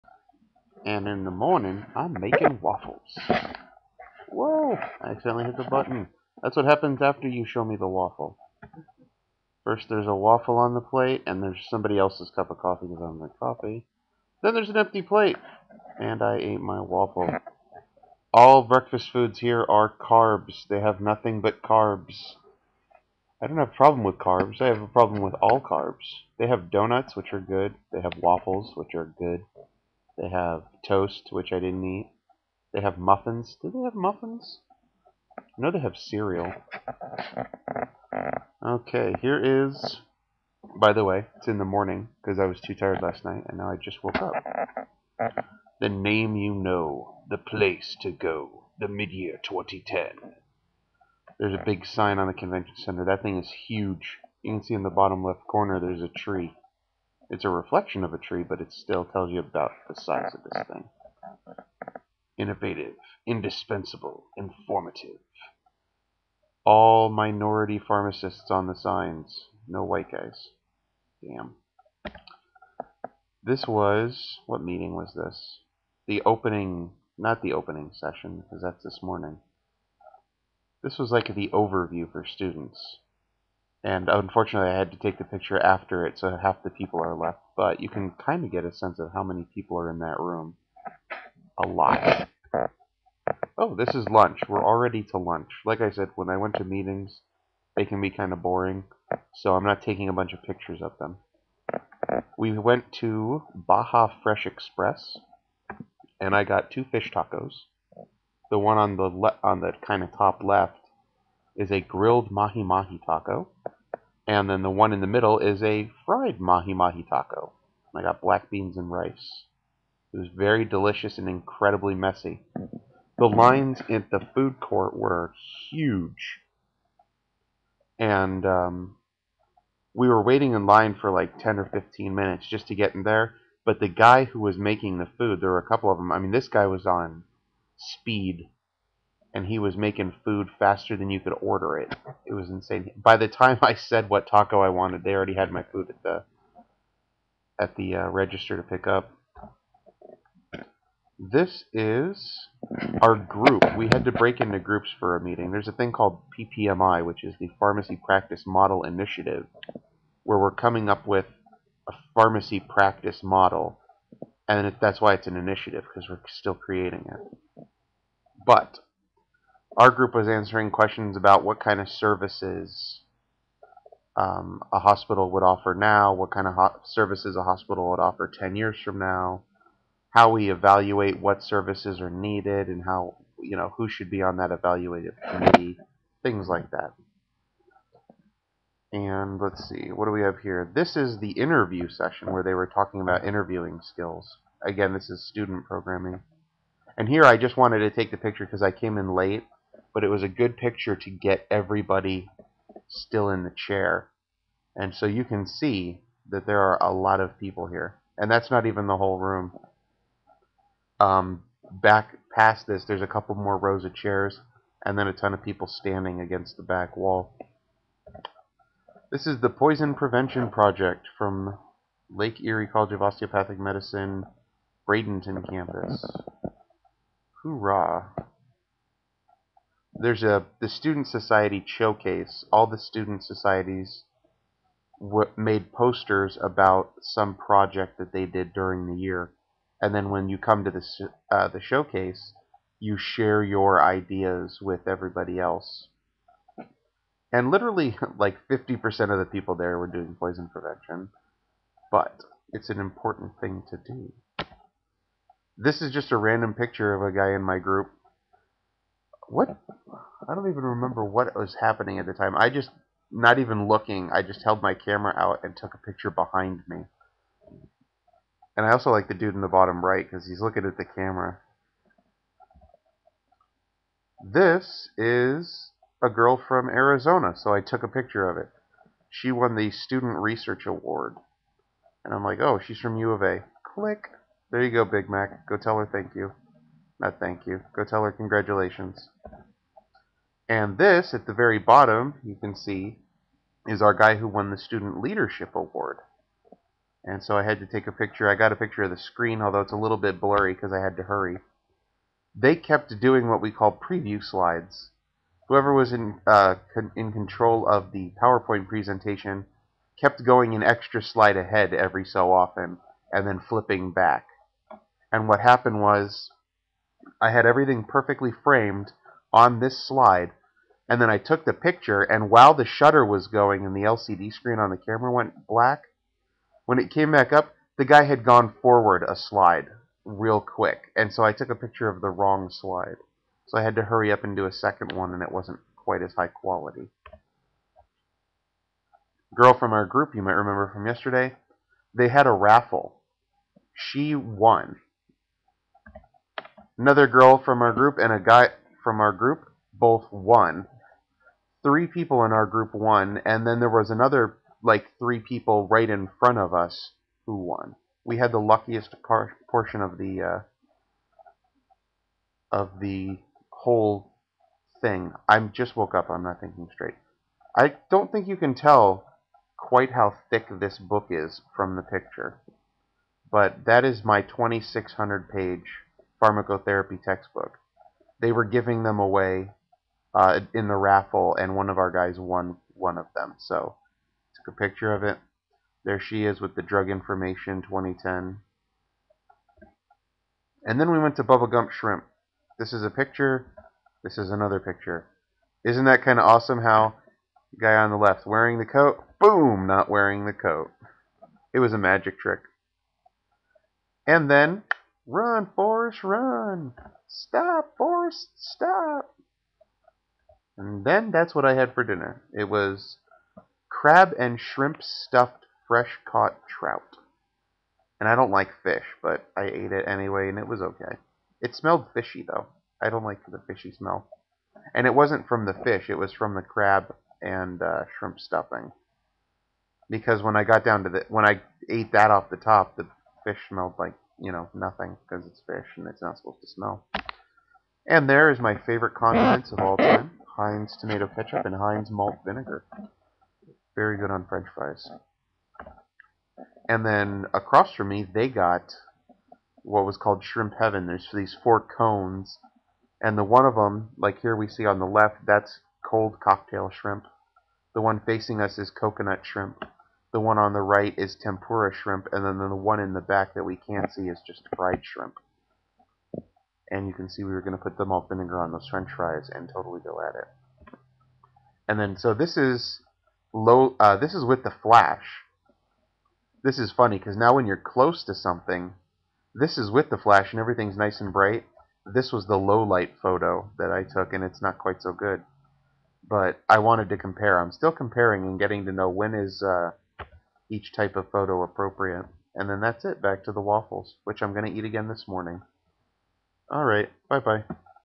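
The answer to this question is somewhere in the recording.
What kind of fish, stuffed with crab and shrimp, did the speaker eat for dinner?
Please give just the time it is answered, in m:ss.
6:56.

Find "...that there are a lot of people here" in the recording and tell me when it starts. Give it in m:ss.
3:26.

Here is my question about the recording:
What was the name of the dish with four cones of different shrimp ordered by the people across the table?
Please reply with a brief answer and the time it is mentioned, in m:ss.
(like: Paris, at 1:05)
Shrimp Heaven, at 7:30.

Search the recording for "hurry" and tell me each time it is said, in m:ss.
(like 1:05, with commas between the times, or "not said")
5:01, 5:33.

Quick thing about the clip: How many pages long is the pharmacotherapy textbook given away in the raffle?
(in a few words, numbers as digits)
2,600.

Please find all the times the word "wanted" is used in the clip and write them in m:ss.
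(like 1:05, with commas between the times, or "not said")
2:24, 3:17, 8:06.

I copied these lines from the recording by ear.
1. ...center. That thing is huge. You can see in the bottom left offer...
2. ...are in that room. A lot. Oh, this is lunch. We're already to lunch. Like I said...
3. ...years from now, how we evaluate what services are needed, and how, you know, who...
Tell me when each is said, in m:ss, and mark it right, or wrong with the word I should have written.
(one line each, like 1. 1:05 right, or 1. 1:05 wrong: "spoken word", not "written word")
1. 0:52 wrong: "corner", not "offer"
2. 1:29 right
3. 2:58 right.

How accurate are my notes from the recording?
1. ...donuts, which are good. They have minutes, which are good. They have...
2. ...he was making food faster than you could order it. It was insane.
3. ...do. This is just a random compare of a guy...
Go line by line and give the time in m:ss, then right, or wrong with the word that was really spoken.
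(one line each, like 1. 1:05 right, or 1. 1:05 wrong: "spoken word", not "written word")
1. 0:26 wrong: "waffles", not "minutes"
2. 2:19 right
3. 4:13 wrong: "picture", not "compare".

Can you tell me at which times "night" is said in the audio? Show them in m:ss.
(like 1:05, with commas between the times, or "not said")
0:43.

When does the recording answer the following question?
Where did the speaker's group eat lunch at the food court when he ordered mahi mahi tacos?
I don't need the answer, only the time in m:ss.
1:43.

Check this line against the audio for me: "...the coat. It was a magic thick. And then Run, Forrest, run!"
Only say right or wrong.
wrong.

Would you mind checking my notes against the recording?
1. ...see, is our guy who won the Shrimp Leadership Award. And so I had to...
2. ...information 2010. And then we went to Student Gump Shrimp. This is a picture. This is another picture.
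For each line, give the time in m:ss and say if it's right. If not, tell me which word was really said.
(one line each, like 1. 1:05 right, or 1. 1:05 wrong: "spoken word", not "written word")
1. 4:52 wrong: "Student", not "Shrimp"
2. 6:26 wrong: "Bubba", not "Student".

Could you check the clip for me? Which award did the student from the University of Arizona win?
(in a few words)
Student Research Award.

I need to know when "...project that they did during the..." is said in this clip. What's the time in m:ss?
3:57.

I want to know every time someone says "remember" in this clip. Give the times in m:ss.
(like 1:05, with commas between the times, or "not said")
4:20, 5:40.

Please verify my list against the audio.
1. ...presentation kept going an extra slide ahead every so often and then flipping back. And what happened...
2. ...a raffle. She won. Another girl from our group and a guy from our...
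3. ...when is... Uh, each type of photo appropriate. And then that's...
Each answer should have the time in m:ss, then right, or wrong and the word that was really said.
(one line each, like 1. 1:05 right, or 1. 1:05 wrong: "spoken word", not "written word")
1. 5:08 right
2. 5:42 right
3. 8:08 right.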